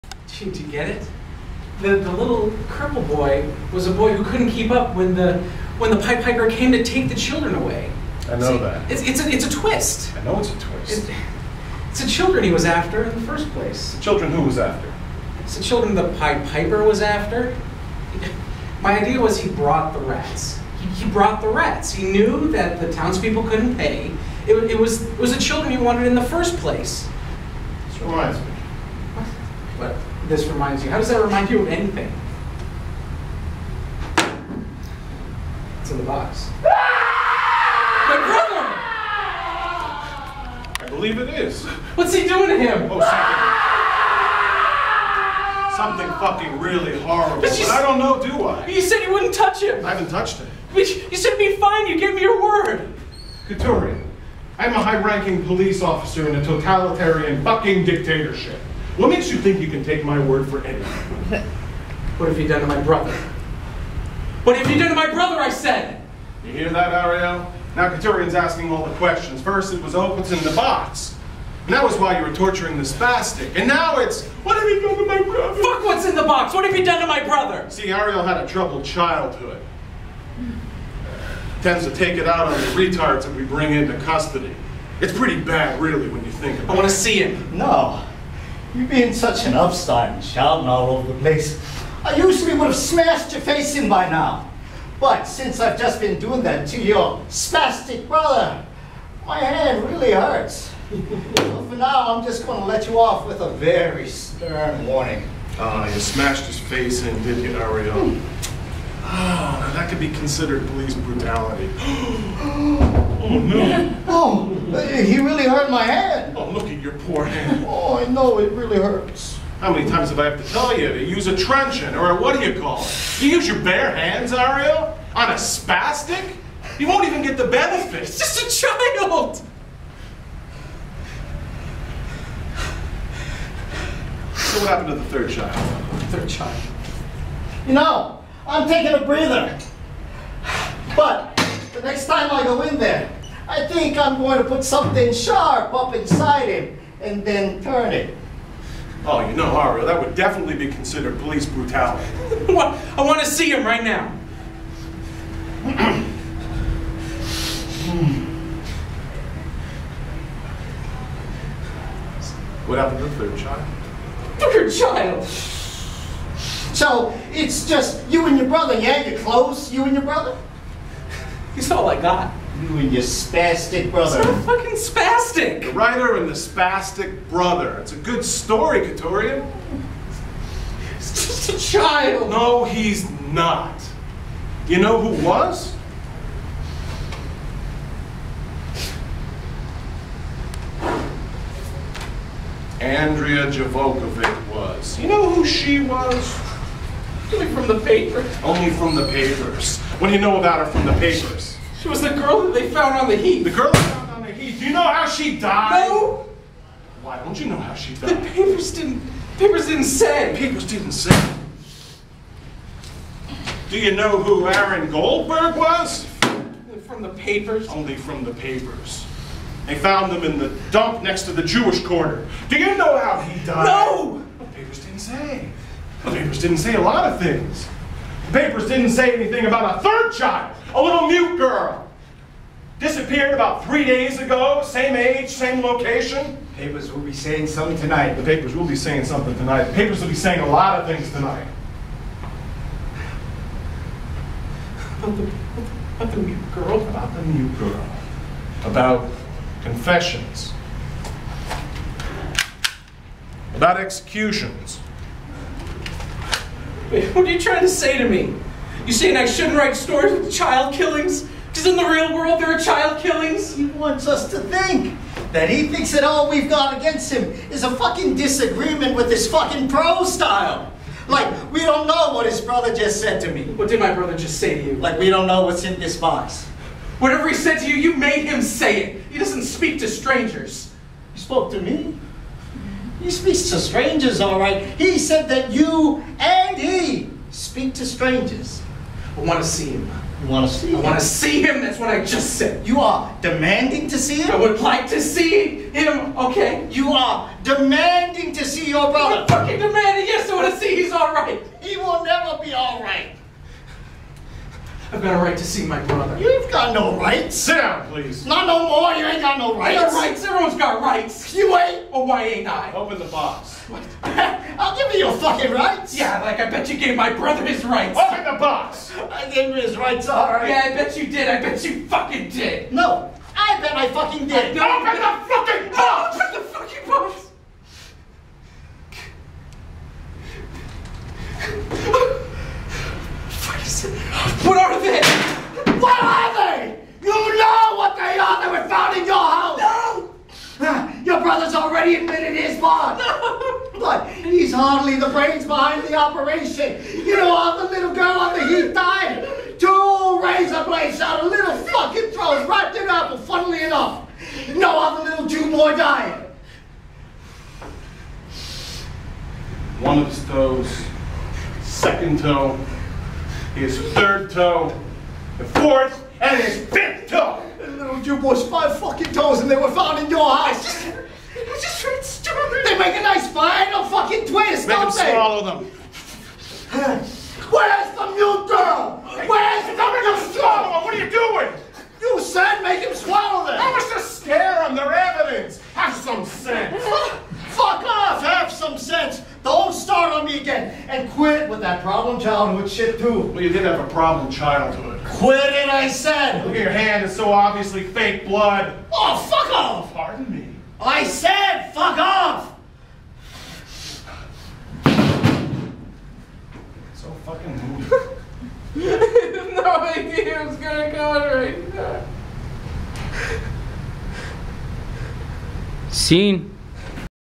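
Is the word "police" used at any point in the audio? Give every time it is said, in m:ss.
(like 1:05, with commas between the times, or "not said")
0:55, 1:50, 2:31.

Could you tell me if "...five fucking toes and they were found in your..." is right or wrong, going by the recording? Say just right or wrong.
right.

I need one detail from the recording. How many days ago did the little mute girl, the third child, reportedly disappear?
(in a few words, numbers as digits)
3.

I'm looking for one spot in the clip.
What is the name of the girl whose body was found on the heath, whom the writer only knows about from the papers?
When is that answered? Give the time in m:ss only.
3:12.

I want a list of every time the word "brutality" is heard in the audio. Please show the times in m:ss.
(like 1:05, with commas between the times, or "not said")
1:50, 2:31.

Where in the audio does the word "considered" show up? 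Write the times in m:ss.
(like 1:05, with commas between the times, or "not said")
1:50, 2:30.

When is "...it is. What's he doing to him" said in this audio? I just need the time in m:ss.
0:41.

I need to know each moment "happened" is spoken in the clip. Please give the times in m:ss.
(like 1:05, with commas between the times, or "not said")
2:14, 2:42.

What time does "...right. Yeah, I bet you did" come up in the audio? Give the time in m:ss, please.
5:20.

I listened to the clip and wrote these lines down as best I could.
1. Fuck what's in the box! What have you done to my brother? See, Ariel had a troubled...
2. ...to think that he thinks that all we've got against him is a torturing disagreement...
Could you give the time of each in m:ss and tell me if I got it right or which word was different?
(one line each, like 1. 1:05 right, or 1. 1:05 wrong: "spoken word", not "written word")
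1. 1:15 right
2. 4:24 wrong: "fucking", not "torturing".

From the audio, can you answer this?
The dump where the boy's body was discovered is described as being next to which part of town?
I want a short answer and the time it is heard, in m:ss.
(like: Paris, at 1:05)
the Jewish quarter, at 3:41.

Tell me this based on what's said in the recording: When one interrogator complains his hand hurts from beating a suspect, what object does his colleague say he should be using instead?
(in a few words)
a truncheon.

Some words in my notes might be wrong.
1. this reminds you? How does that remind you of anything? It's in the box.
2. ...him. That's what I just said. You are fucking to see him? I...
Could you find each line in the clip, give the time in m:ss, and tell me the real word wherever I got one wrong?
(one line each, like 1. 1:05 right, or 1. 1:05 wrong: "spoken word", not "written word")
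1. 0:30 right
2. 4:51 wrong: "demanding", not "fucking".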